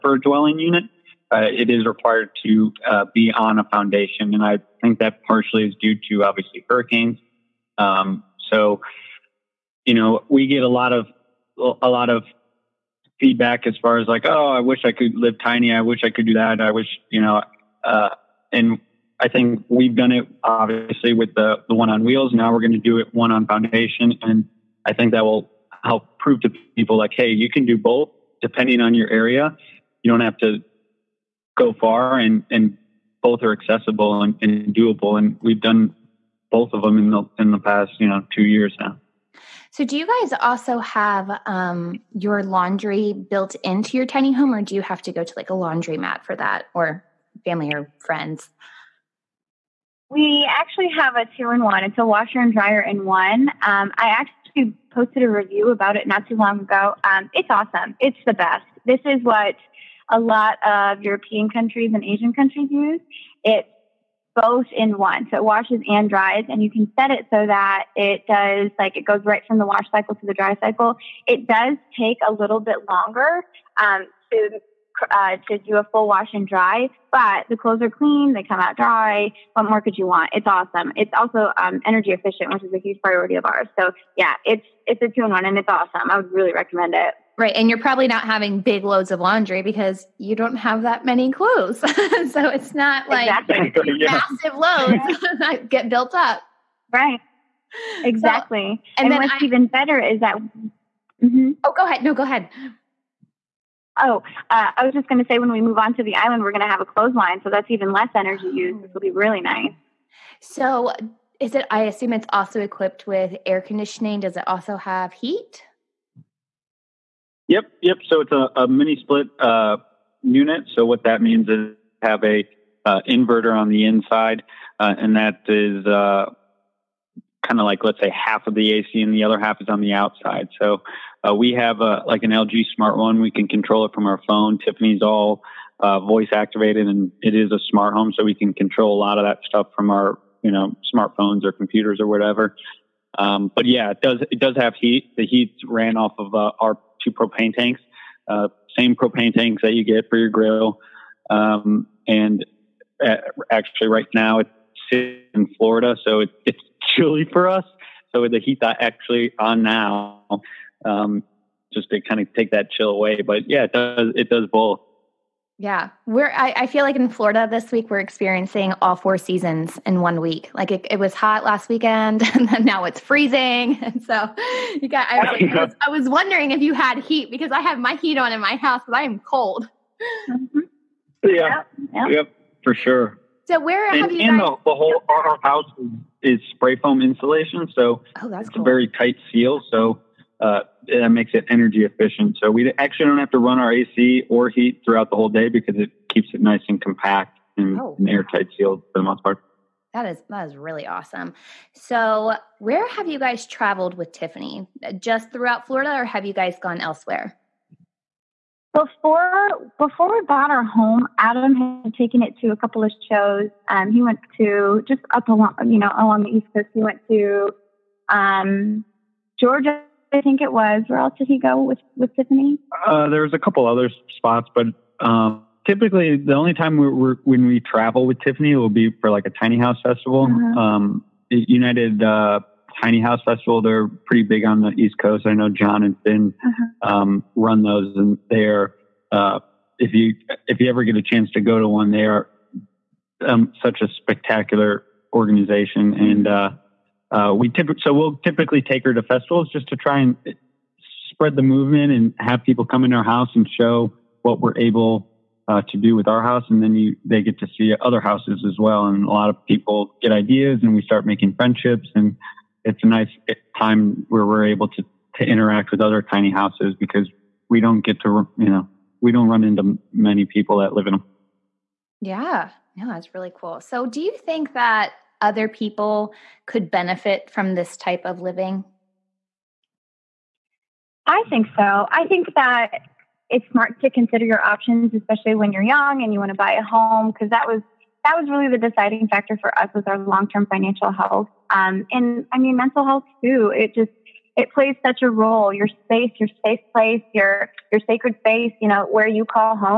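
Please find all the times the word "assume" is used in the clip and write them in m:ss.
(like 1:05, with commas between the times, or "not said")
1:51.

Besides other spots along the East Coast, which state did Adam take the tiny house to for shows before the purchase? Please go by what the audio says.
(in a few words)
Georgia.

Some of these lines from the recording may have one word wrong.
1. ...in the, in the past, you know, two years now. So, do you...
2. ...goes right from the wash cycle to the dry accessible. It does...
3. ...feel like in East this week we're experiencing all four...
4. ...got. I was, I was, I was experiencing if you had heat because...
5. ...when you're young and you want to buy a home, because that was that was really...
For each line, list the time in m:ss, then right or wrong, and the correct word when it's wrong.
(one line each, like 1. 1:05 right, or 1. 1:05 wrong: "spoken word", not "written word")
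1. 0:36 right
2. 1:09 wrong: "cycle", not "accessible"
3. 2:46 wrong: "Florida", not "East"
4. 2:54 wrong: "wondering", not "experiencing"
5. 4:45 right.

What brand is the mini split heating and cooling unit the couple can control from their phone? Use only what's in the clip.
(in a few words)
LG.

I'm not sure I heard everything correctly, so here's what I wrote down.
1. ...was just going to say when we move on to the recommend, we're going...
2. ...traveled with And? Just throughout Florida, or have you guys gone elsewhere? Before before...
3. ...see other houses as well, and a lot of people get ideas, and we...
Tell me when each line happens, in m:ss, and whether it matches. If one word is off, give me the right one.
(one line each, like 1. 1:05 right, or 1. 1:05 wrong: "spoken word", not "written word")
1. 1:44 wrong: "island", not "recommend"
2. 3:23 wrong: "Tiffany", not "And"
3. 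4:17 right.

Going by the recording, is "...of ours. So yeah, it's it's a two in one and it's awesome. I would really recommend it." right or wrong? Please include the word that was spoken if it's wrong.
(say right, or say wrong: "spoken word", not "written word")
right.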